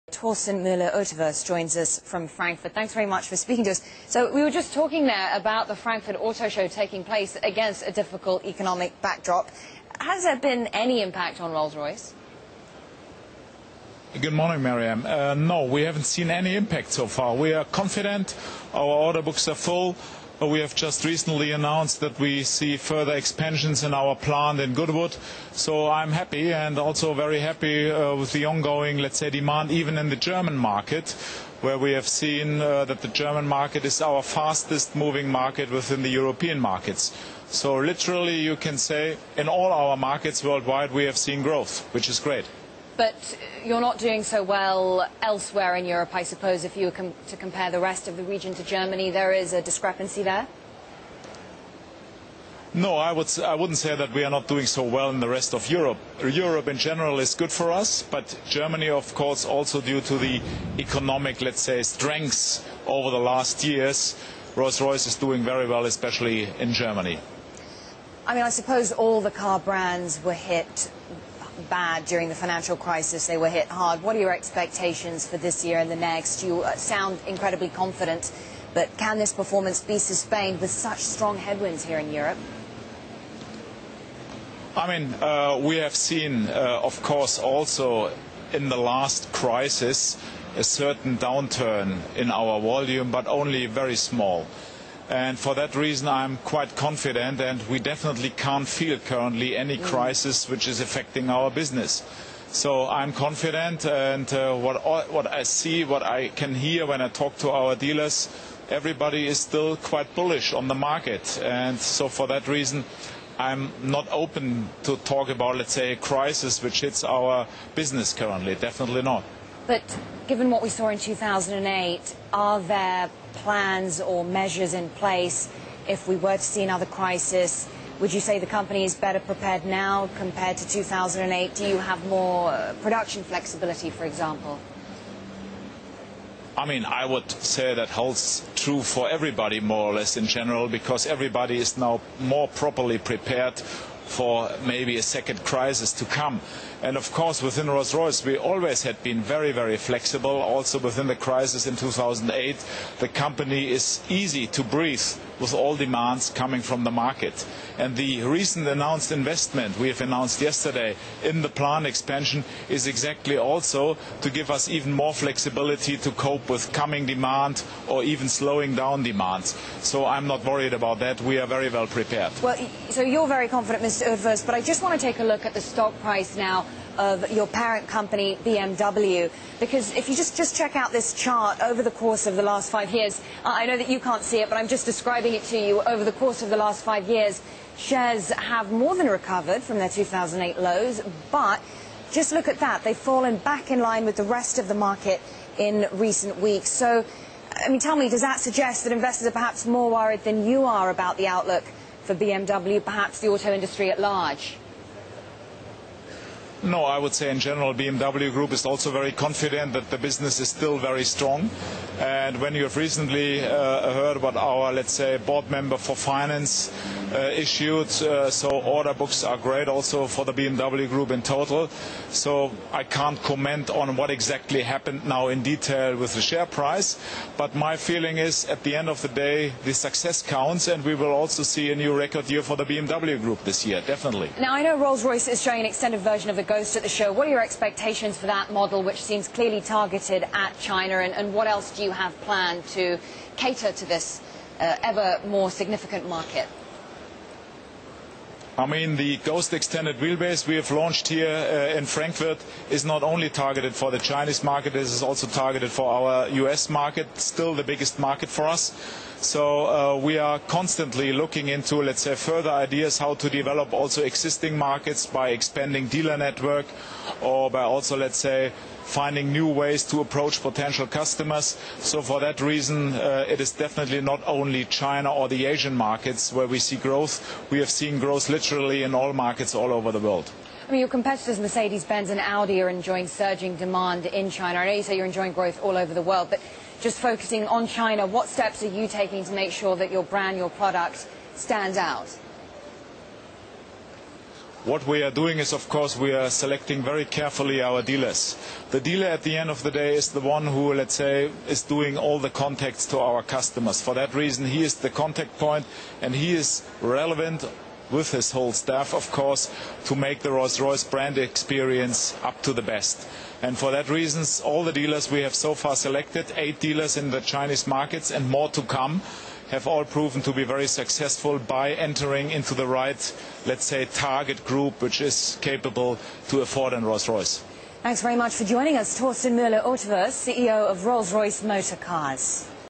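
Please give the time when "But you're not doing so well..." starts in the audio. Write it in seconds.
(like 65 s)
42 s.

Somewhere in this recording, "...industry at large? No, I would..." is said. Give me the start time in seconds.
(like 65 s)
203 s.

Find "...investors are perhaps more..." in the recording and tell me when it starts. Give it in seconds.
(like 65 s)
198 s.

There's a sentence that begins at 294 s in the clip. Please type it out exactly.
What we are doing is, of course, we are selecting very carefully our dealers.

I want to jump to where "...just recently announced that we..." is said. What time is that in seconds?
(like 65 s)
20 s.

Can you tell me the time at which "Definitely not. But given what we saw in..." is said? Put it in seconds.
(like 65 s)
118 s.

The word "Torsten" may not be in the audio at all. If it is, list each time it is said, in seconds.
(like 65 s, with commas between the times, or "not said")
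0 s, 328 s.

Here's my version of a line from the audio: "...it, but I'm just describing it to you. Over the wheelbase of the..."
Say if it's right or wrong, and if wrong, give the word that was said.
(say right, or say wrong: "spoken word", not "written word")
wrong: "course", not "wheelbase".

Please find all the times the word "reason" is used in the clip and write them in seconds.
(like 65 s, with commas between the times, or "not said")
95 s, 112 s, 272 s, 304 s, 313 s.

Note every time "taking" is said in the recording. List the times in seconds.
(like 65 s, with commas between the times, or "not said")
6 s, 288 s.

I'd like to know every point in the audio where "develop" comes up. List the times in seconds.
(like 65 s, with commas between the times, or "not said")
263 s.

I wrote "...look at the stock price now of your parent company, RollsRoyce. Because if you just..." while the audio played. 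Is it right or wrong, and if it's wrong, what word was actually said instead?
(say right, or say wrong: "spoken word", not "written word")
wrong: "BMW", not "RollsRoyce".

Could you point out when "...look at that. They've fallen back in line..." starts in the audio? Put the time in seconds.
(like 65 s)
192 s.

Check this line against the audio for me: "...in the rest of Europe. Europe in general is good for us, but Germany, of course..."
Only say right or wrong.
right.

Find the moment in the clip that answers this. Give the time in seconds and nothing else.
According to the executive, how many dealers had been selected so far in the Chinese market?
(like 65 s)
316 s.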